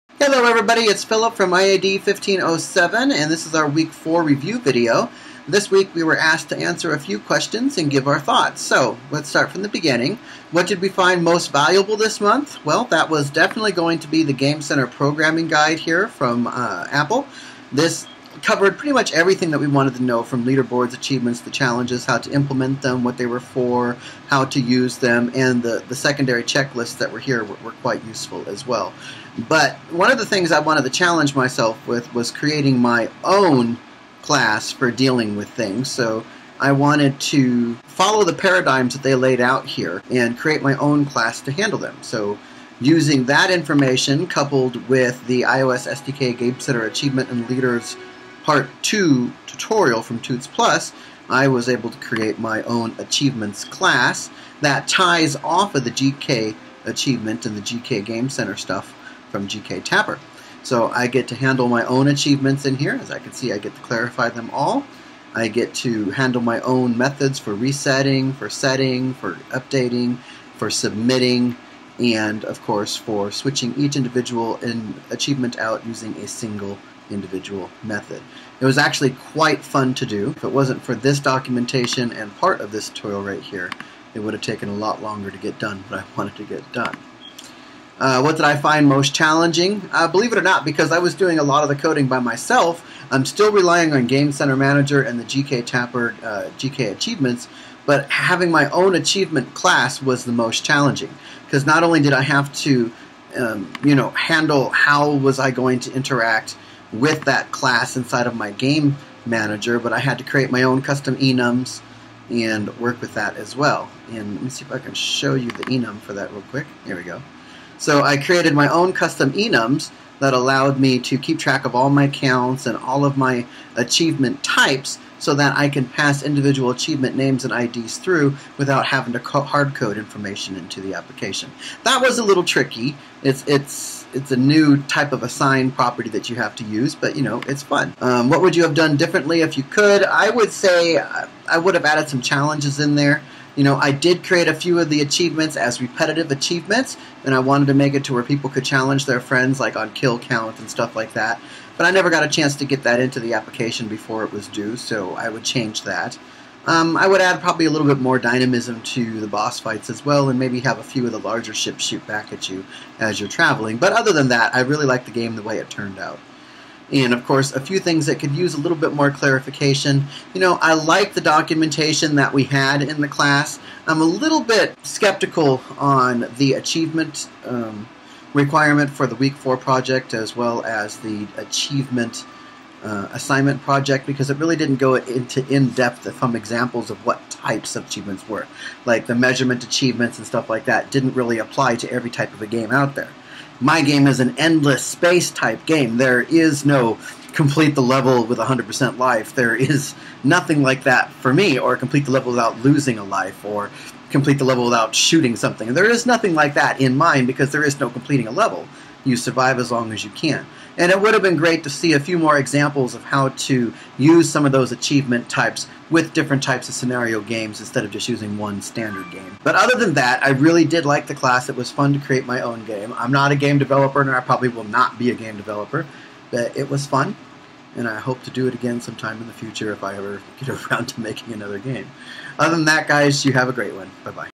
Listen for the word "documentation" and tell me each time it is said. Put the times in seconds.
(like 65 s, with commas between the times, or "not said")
81 s, 171 s.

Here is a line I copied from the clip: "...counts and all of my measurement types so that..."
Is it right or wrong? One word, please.
wrong.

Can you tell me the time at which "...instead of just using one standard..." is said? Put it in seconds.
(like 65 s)
217 s.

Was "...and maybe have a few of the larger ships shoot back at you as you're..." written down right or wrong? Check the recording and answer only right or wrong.
right.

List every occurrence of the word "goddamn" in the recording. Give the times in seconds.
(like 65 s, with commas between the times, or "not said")
not said.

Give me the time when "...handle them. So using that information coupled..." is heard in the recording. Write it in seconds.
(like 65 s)
41 s.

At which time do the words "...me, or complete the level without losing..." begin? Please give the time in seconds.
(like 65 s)
201 s.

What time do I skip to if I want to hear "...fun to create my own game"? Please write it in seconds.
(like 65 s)
221 s.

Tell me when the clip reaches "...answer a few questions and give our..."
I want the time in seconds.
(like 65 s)
6 s.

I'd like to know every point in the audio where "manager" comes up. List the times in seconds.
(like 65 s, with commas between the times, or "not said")
94 s, 109 s.